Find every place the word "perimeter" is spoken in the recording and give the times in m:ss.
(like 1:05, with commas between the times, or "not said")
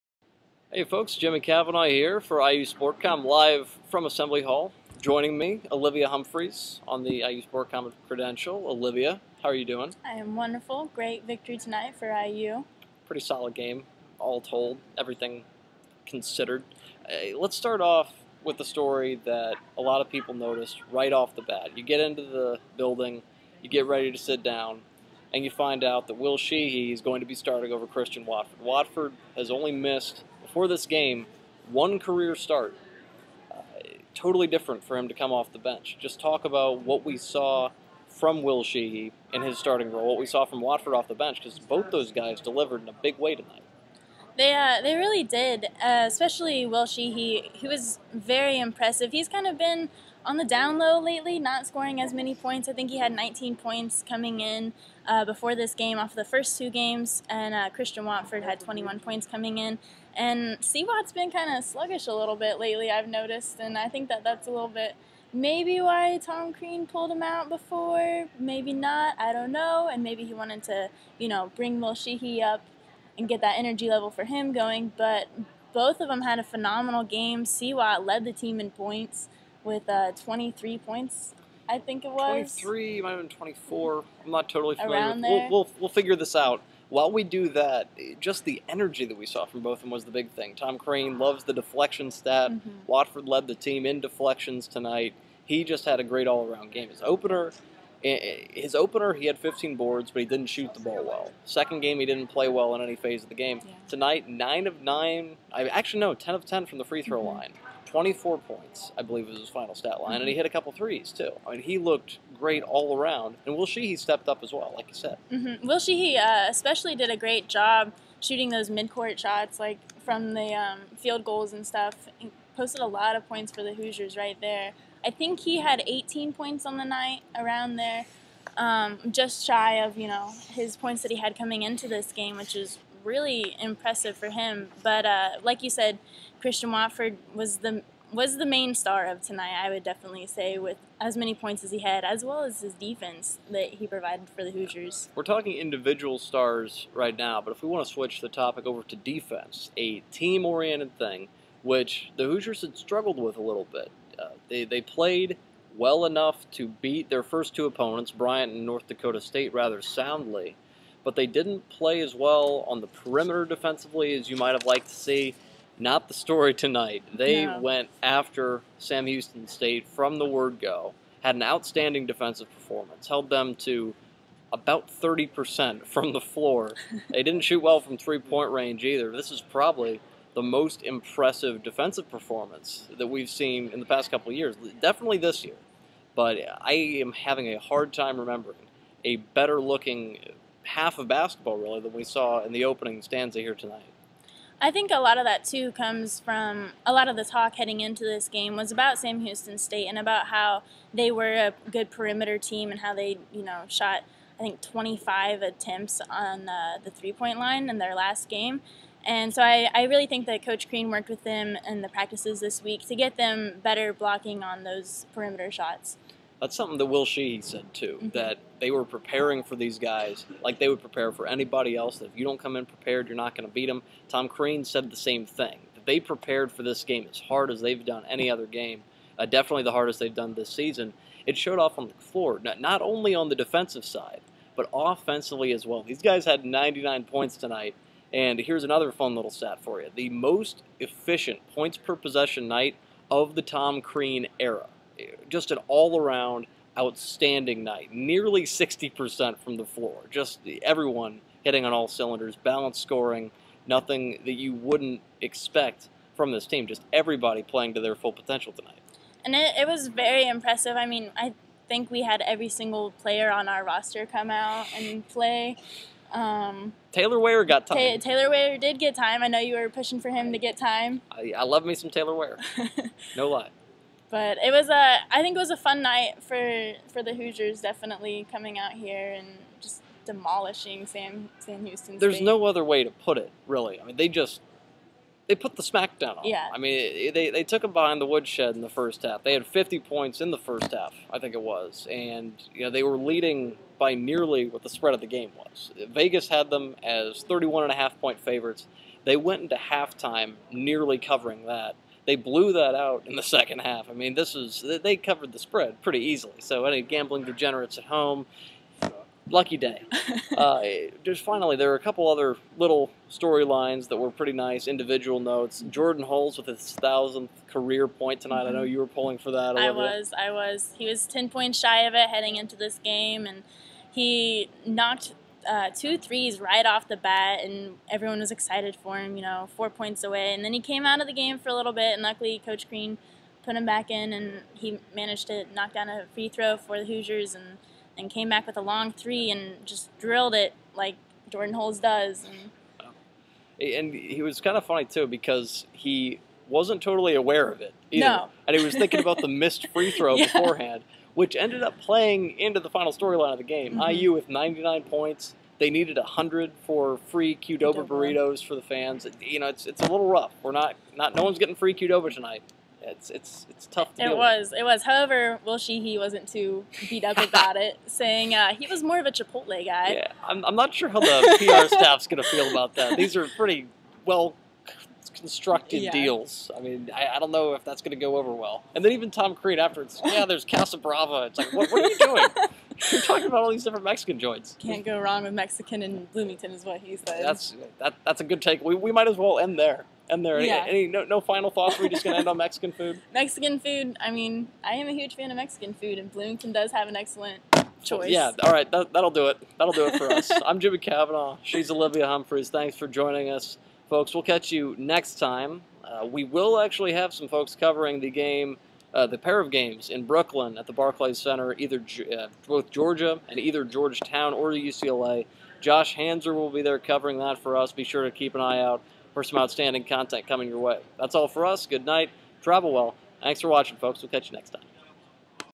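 2:42, 3:21, 3:35.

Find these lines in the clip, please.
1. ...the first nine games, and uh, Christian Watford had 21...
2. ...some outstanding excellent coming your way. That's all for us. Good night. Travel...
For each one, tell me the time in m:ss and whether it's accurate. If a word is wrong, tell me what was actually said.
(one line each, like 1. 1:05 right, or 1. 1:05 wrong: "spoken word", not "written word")
1. 0:56 wrong: "two", not "nine"
2. 6:59 wrong: "content", not "excellent".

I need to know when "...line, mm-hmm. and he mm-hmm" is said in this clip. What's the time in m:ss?
1:50.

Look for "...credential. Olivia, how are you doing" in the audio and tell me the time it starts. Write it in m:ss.
0:08.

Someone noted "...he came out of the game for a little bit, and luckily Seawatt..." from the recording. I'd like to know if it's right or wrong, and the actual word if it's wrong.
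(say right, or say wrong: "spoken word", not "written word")
wrong: "Coach", not "Seawatt".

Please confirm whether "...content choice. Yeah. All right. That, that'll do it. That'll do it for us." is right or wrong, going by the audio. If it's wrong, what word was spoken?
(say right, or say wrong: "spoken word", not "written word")
wrong: "excellent", not "content".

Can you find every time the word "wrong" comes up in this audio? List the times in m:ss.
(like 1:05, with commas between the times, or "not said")
6:24.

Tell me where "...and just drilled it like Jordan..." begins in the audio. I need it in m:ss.
5:39.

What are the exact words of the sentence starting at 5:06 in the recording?
So any gambling degenerates at home, lucky day.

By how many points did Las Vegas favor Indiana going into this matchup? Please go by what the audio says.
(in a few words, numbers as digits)
31.5.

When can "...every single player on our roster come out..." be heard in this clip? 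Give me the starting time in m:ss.
4:22.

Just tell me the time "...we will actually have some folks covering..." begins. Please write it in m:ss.
6:46.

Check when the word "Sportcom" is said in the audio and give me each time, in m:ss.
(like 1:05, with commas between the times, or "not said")
0:02, 0:07.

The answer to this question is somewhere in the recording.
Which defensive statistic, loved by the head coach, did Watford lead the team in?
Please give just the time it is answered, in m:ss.
1:34.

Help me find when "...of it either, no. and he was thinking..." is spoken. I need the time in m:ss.
5:47.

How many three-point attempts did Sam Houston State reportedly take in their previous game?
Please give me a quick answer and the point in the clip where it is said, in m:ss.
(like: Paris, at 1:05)
25, at 3:24.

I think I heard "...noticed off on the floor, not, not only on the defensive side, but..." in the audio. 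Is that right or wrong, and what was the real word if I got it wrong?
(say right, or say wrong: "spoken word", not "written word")
wrong: "showed", not "noticed".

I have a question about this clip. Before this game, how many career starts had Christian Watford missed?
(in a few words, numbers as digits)
1.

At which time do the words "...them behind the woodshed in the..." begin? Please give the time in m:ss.
4:47.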